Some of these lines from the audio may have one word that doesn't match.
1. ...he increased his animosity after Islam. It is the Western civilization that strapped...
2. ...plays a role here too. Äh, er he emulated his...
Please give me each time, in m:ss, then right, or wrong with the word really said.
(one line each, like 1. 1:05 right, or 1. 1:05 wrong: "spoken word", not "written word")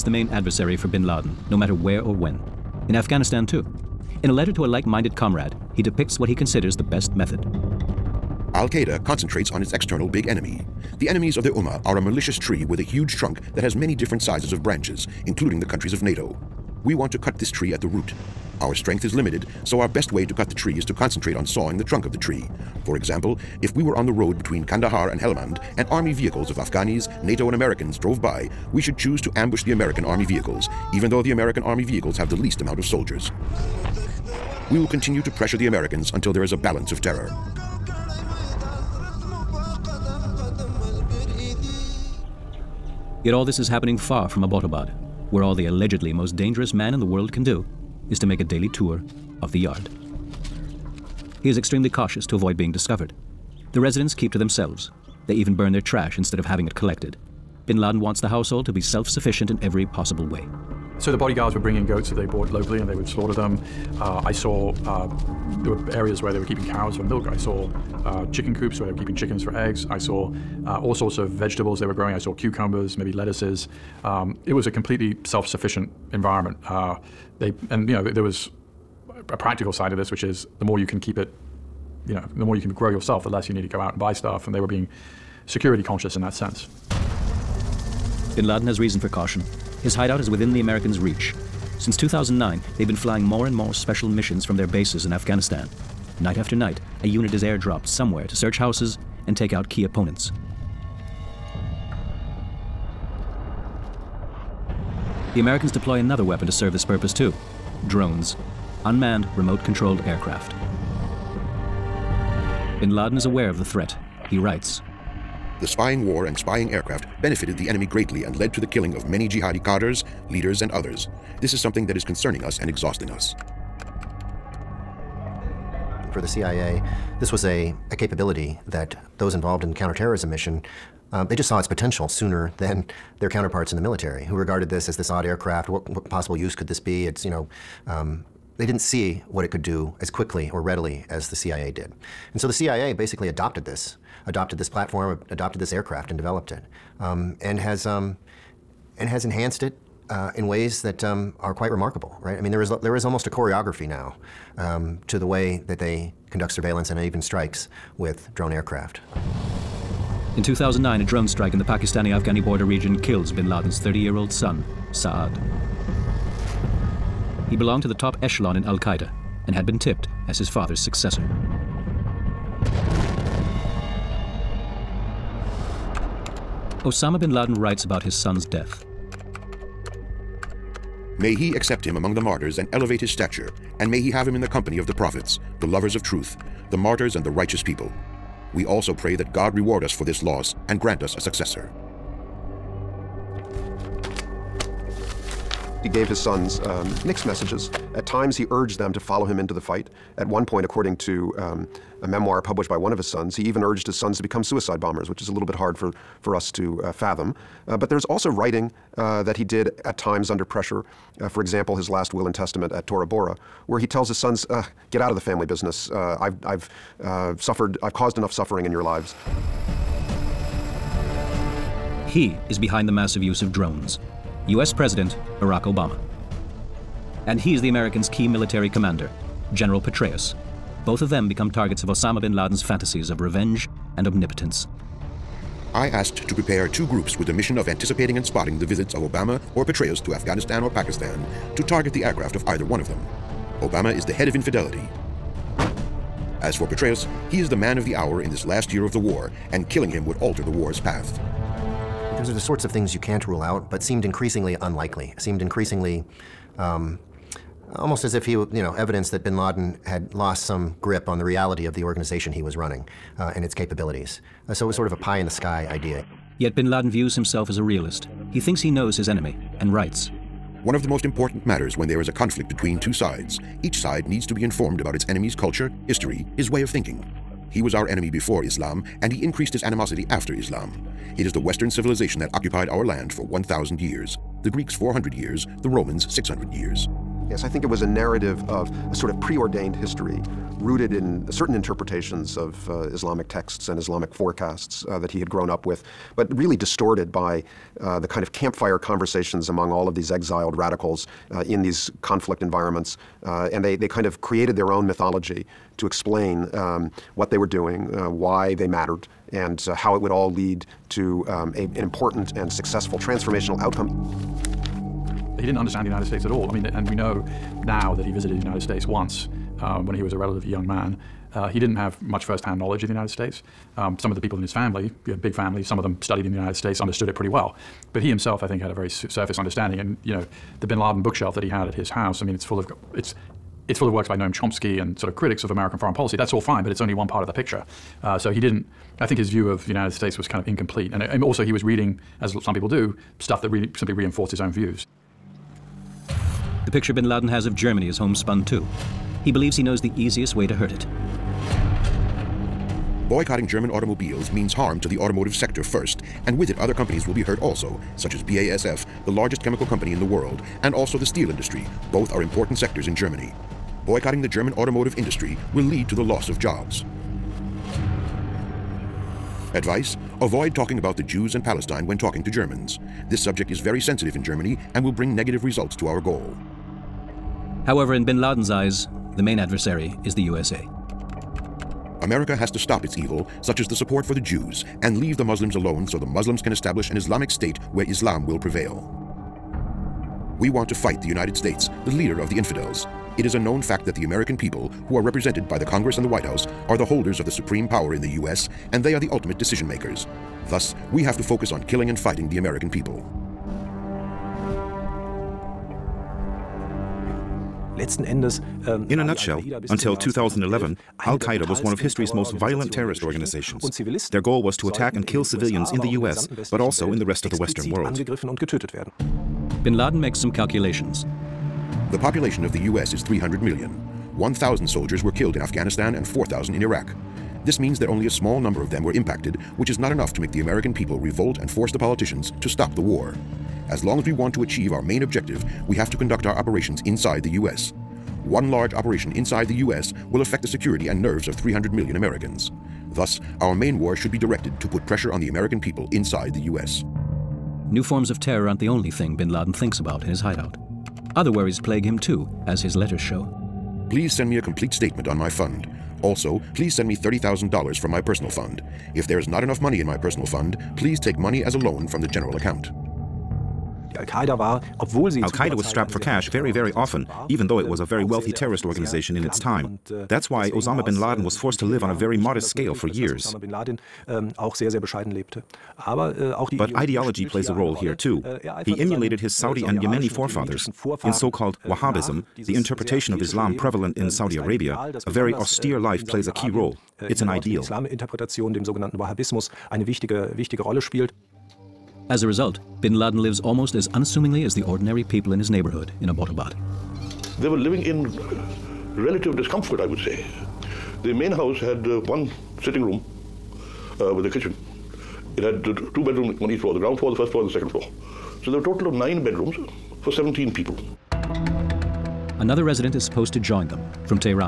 1. 4:39 wrong: "occupied", not "strapped"
2. 7:57 right.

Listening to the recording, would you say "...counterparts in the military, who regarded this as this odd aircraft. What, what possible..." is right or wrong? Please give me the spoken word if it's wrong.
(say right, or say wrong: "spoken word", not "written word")
right.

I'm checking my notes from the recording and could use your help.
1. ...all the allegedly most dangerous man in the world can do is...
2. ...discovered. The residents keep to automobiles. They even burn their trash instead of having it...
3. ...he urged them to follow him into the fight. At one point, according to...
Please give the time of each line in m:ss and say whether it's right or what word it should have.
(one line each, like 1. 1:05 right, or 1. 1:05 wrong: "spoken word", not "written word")
1. 0:45 right
2. 0:52 wrong: "themselves", not "automobiles"
3. 3:18 right.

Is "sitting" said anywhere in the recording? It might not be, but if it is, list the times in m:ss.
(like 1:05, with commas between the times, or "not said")
8:22.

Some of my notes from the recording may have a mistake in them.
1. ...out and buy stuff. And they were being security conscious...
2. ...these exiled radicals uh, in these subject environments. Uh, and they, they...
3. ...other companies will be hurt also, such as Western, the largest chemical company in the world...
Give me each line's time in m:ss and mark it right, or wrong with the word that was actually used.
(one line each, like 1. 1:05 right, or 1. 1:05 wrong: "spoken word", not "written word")
1. 1:23 right
2. 4:59 wrong: "conflict", not "subject"
3. 5:56 wrong: "BASF", not "Western".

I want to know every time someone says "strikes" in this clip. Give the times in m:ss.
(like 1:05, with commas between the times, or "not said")
2:37, 2:41.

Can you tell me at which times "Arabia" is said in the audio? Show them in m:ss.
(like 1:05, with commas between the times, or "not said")
8:04.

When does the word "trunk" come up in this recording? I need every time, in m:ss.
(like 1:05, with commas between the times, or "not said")
0:13, 0:21.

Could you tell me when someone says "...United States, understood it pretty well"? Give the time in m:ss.
5:26.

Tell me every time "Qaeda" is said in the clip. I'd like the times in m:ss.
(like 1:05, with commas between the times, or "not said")
0:08, 2:48, 6:51, 7:44.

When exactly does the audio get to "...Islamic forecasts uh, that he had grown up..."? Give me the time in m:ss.
4:53.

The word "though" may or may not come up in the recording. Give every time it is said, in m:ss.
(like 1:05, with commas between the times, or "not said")
0:31, 7:47.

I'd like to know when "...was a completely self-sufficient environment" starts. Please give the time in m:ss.
1:14.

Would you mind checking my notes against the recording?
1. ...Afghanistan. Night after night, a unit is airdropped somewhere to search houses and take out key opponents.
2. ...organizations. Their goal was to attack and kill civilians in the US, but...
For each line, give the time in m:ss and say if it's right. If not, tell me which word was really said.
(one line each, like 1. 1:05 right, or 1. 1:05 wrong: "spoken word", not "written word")
1. 1:35 right
2. 6:53 right.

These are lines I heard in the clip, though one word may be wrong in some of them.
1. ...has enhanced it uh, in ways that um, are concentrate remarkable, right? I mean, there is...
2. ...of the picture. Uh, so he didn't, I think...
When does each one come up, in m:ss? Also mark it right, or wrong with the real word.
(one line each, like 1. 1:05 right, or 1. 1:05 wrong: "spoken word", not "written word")
1. 2:29 wrong: "quite", not "concentrate"
2. 5:37 right.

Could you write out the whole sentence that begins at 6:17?
However, in bin Laden's eyes, the main adversary is the USA.